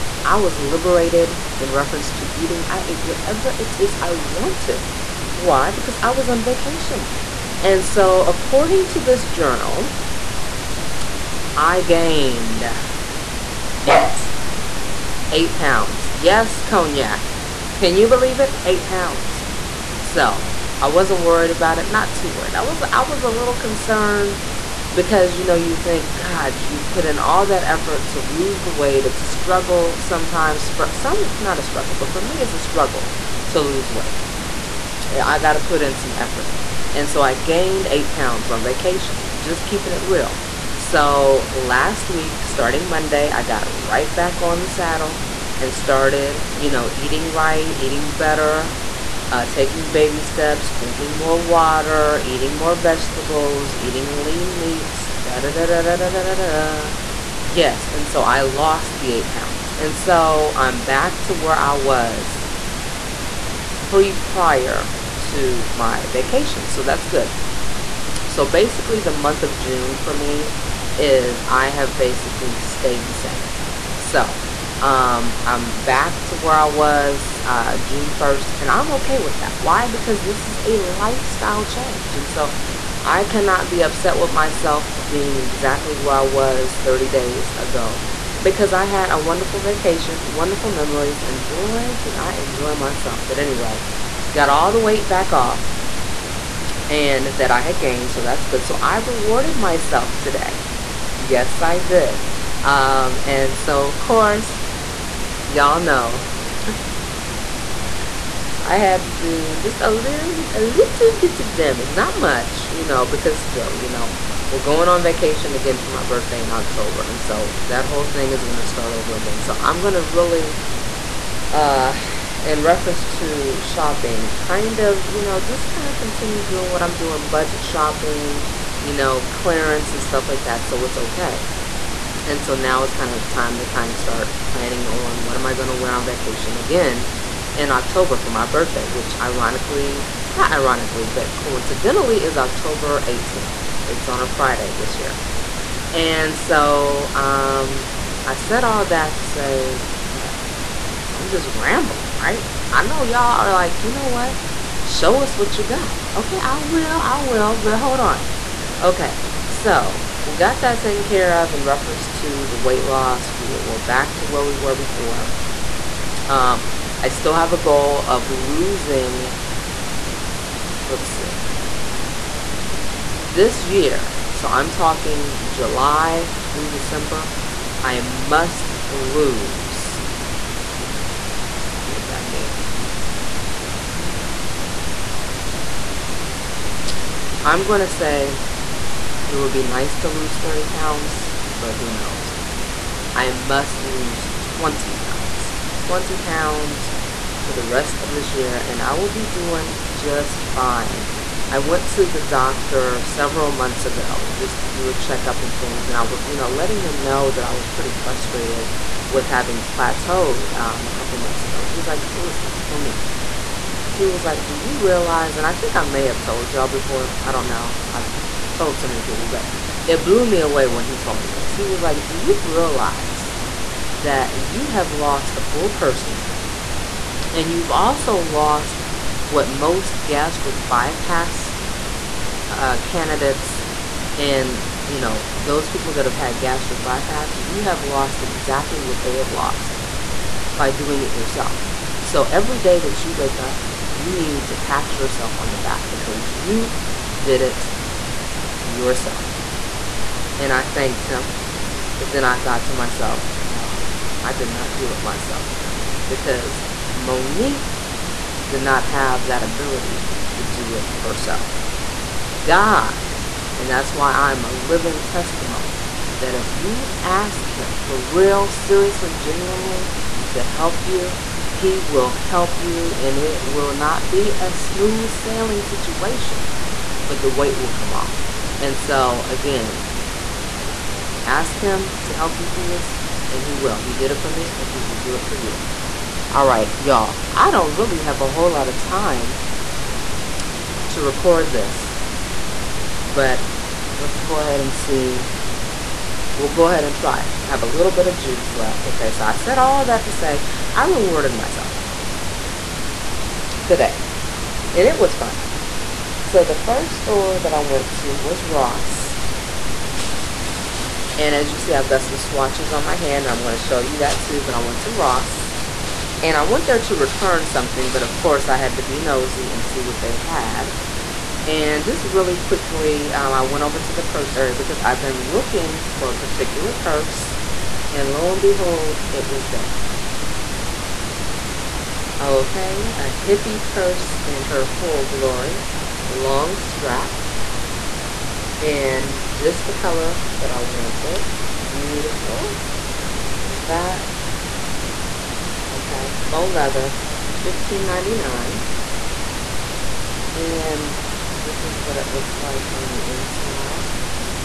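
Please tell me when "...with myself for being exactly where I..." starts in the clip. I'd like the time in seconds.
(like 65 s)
84 s.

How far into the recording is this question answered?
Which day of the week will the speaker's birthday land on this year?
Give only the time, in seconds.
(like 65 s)
144 s.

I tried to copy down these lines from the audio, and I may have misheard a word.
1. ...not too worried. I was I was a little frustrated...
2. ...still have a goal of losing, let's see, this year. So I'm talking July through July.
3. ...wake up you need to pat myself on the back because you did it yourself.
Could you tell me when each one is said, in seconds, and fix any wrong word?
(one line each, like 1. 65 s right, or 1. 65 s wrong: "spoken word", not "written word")
1. 21 s wrong: "concerned", not "frustrated"
2. 167 s wrong: "December", not "July"
3. 243 s wrong: "yourself", not "myself".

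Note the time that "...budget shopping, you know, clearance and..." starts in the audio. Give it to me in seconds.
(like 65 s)
127 s.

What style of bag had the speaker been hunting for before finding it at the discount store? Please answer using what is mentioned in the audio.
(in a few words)
hippie purse.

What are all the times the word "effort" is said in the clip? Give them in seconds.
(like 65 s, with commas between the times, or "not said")
27 s, 36 s.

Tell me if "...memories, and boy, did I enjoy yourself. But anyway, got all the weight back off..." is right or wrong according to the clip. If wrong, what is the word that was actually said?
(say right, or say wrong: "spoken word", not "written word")
wrong: "myself", not "yourself".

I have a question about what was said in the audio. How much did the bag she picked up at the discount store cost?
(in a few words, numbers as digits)
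$15.99.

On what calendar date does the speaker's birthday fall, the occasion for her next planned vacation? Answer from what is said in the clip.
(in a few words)
October 18th.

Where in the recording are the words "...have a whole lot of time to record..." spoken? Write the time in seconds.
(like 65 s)
288 s.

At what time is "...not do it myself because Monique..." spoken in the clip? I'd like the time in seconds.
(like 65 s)
254 s.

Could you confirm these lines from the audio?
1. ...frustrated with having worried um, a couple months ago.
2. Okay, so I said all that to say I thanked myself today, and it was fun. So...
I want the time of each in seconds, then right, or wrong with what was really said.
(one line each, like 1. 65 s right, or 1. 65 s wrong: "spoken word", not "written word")
1. 207 s wrong: "plateaued", not "worried"
2. 298 s wrong: "rewarded", not "thanked".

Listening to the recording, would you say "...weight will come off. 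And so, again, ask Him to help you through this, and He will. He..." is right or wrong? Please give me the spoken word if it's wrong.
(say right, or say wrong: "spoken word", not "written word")
right.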